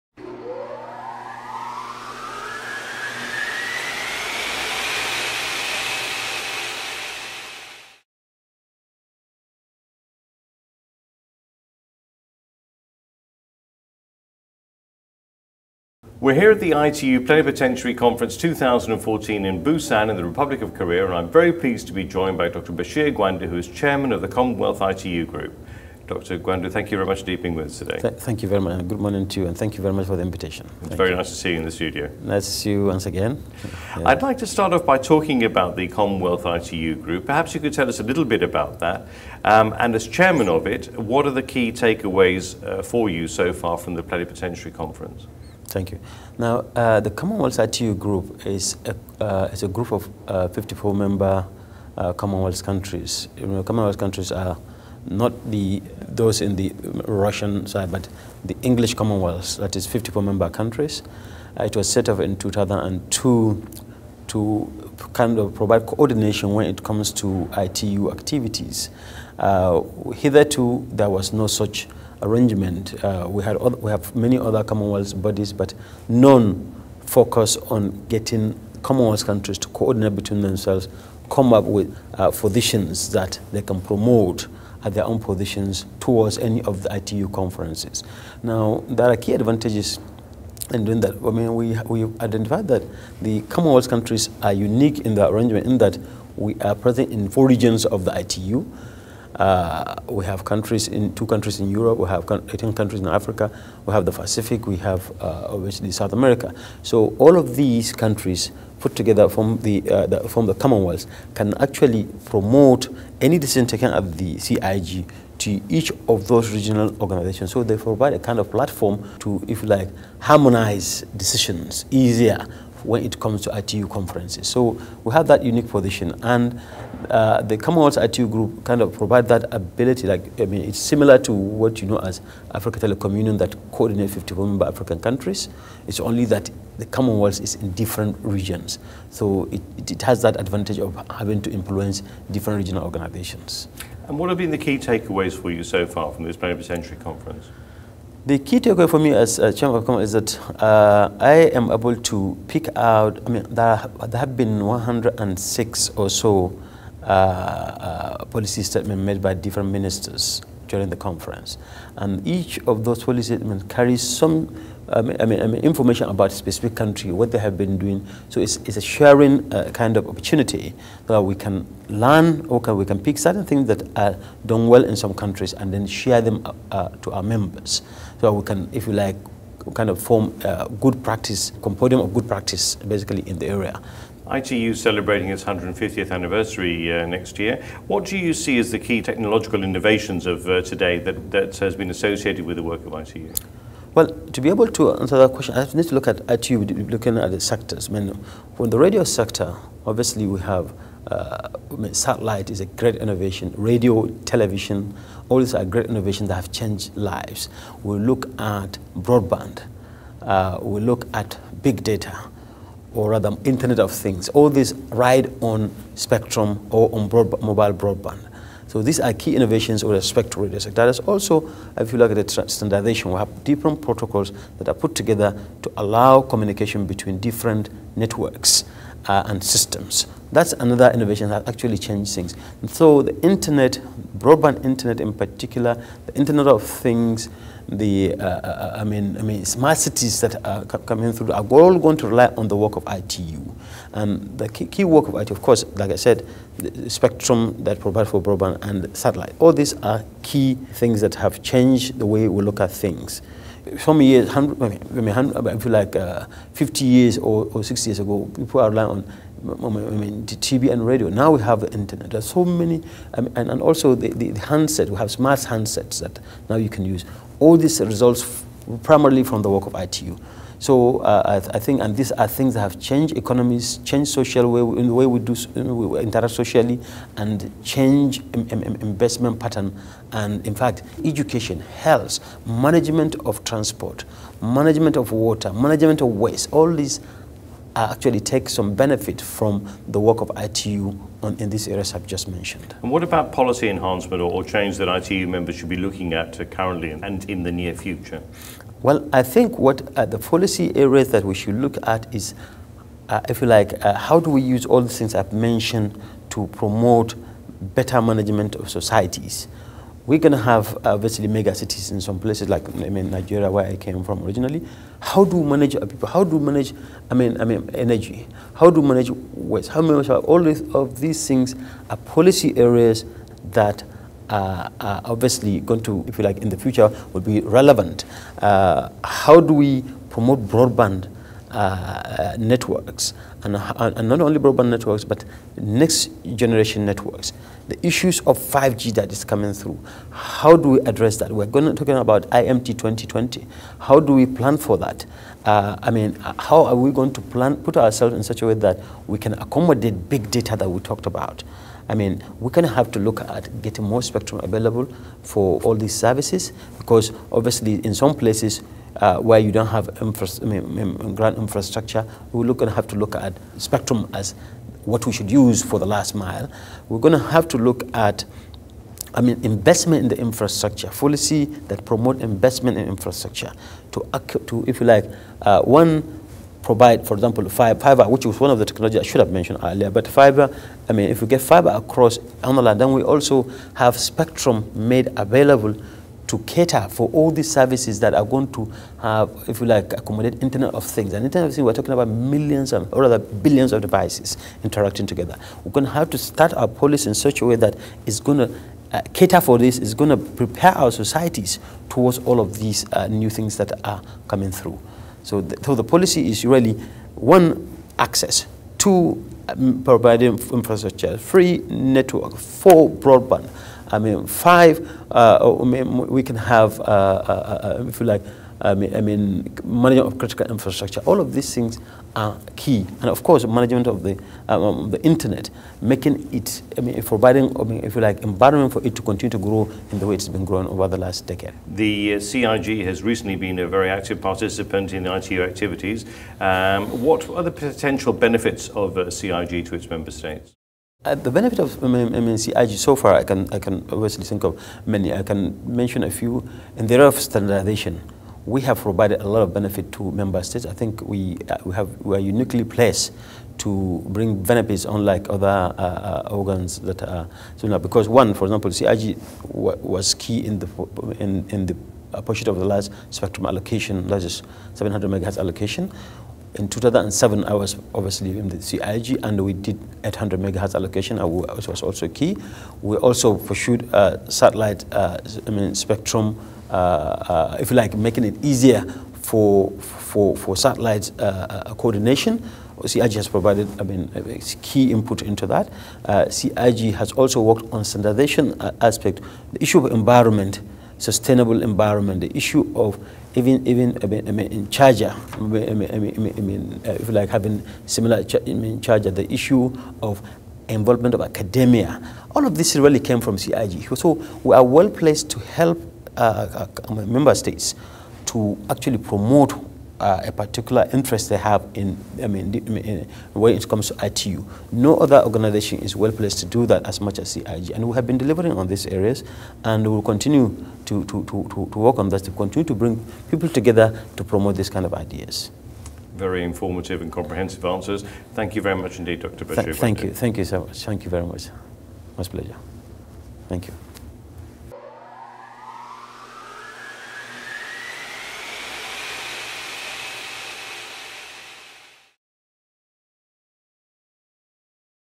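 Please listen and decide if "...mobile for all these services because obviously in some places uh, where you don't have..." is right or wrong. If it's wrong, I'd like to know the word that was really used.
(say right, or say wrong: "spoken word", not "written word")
wrong: "available", not "mobile".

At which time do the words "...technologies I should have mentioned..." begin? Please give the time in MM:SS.
06:18.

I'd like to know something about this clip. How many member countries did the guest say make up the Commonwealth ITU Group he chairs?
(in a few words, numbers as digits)
54.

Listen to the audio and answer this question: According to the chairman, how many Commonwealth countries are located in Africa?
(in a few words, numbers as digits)
18.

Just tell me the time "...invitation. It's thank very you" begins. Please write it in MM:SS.
00:30.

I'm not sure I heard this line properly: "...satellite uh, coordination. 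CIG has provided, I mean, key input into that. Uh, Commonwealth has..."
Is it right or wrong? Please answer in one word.
wrong.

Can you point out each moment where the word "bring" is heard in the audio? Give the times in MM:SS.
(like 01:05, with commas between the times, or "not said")
07:34, 08:42.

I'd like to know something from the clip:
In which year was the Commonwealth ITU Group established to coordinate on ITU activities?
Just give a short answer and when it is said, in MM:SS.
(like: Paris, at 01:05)
2002, at 01:02.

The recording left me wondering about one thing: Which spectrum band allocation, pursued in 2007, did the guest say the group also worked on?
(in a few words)
800 megahertz.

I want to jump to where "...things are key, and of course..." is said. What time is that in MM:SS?
07:01.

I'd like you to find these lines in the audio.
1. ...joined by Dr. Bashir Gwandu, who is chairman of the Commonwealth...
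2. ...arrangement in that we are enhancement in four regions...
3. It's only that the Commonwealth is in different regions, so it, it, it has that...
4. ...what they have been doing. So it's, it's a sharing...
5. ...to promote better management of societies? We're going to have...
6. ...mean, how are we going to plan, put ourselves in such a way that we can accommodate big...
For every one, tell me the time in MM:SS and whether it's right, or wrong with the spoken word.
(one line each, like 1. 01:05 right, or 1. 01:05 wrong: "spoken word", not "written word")
1. 00:22 right
2. 01:35 wrong: "present", not "enhancement"
3. 02:15 right
4. 02:47 right
5. 05:06 right
6. 05:45 right.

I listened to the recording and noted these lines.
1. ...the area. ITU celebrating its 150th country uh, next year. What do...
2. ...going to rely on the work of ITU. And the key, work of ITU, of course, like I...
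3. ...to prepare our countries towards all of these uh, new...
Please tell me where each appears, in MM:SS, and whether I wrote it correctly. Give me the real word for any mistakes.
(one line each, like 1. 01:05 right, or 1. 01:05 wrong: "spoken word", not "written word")
1. 03:03 wrong: "anniversary", not "country"
2. 04:01 right
3. 06:40 wrong: "societies", not "countries".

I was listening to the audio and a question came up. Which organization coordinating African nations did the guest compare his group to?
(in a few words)
Africa Telecom Union.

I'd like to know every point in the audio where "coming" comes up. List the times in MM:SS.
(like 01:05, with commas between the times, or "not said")
04:00, 05:39, 06:44.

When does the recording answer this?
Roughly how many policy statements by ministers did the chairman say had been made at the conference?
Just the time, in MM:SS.
02:34.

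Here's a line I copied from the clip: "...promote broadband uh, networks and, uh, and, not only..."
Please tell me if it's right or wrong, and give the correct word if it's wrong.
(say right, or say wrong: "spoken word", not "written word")
right.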